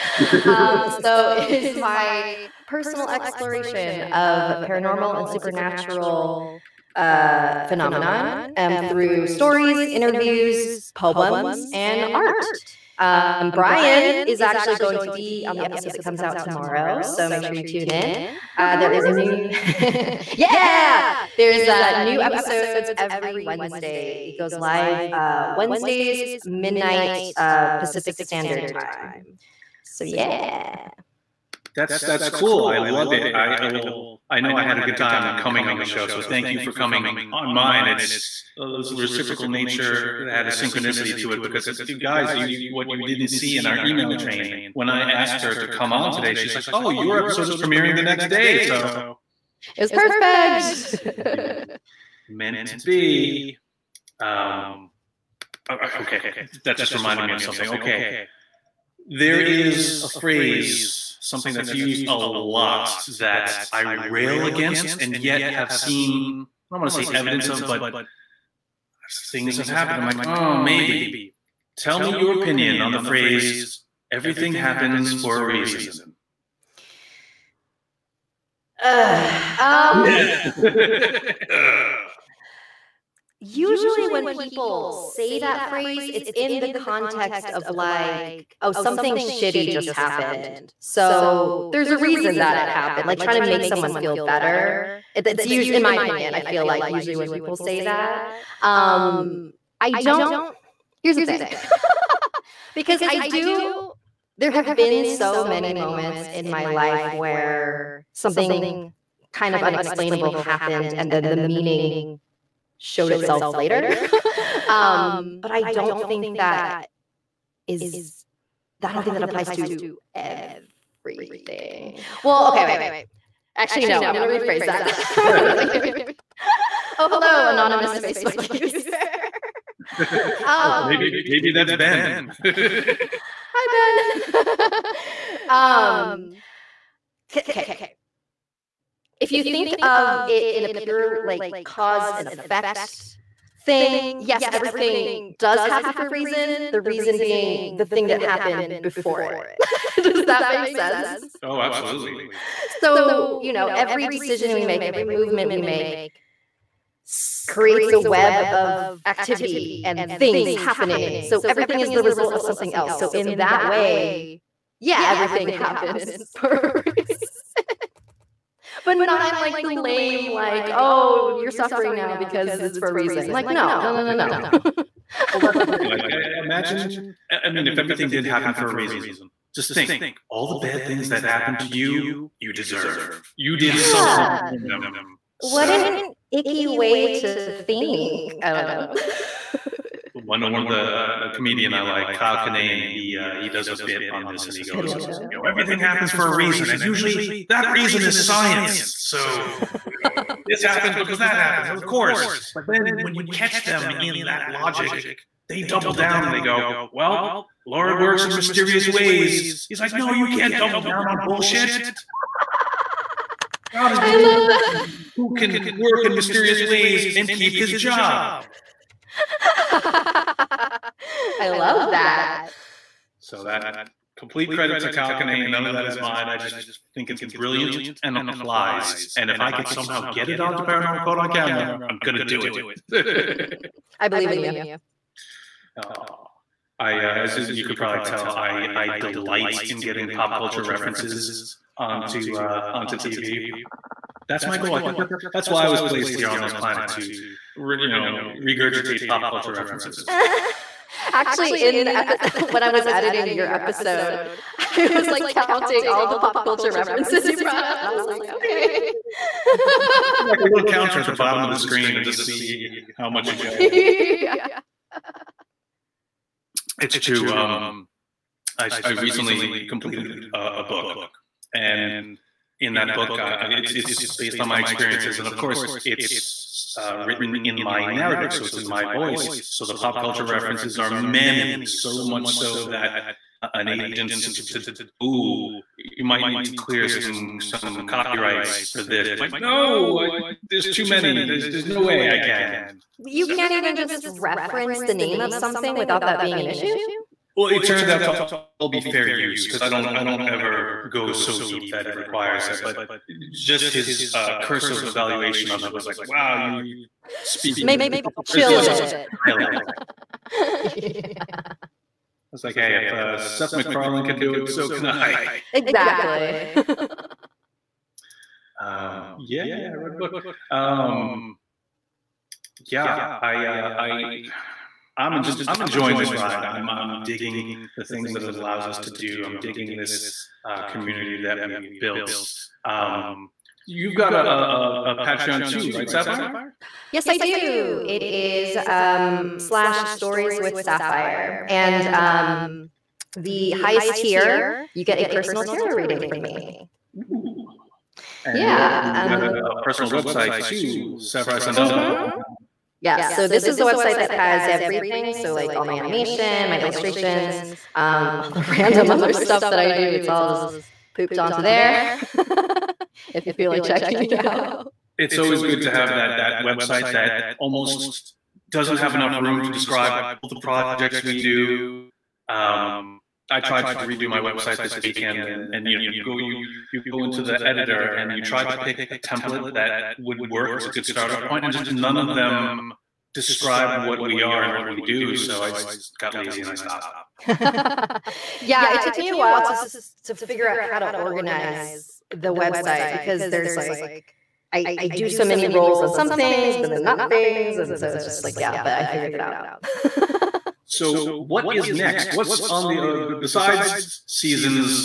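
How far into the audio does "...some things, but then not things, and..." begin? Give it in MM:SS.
06:35.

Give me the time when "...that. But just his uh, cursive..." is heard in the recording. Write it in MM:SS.
05:02.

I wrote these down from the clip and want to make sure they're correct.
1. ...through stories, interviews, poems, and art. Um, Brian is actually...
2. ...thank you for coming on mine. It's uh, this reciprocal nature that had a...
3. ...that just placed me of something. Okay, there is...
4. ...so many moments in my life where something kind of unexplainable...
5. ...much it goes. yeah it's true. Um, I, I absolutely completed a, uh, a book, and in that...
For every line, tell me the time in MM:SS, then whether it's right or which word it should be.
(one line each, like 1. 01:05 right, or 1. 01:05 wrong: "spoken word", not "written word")
1. 00:08 right
2. 00:36 right
3. 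00:56 wrong: "reminded", not "placed"
4. 01:45 right
5. 04:23 wrong: "recently", not "absolutely".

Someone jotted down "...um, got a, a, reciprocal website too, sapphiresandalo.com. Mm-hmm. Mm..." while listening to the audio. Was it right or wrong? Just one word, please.
wrong.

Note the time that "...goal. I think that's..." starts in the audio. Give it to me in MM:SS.
04:04.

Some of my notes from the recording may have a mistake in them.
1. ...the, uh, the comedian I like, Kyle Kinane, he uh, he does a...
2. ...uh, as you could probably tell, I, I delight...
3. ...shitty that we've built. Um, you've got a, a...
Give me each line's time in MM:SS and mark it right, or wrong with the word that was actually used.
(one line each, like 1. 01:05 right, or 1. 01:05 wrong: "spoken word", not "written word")
1. 03:10 right
2. 03:56 right
3. 05:30 wrong: "community", not "shitty".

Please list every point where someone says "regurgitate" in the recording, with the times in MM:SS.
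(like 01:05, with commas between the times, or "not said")
04:08.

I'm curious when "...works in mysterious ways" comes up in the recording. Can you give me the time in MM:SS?
03:27.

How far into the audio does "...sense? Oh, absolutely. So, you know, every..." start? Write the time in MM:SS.
02:30.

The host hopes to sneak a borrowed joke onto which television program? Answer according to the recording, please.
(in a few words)
Paranormal Caught on Camera.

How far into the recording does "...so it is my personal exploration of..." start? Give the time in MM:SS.
00:01.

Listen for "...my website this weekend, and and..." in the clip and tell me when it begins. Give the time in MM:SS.
06:14.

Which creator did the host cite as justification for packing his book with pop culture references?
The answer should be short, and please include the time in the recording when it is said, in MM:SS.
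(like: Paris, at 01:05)
Seth MacFarlane, at 05:13.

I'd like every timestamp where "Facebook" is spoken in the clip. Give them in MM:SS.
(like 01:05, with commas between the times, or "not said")
02:07.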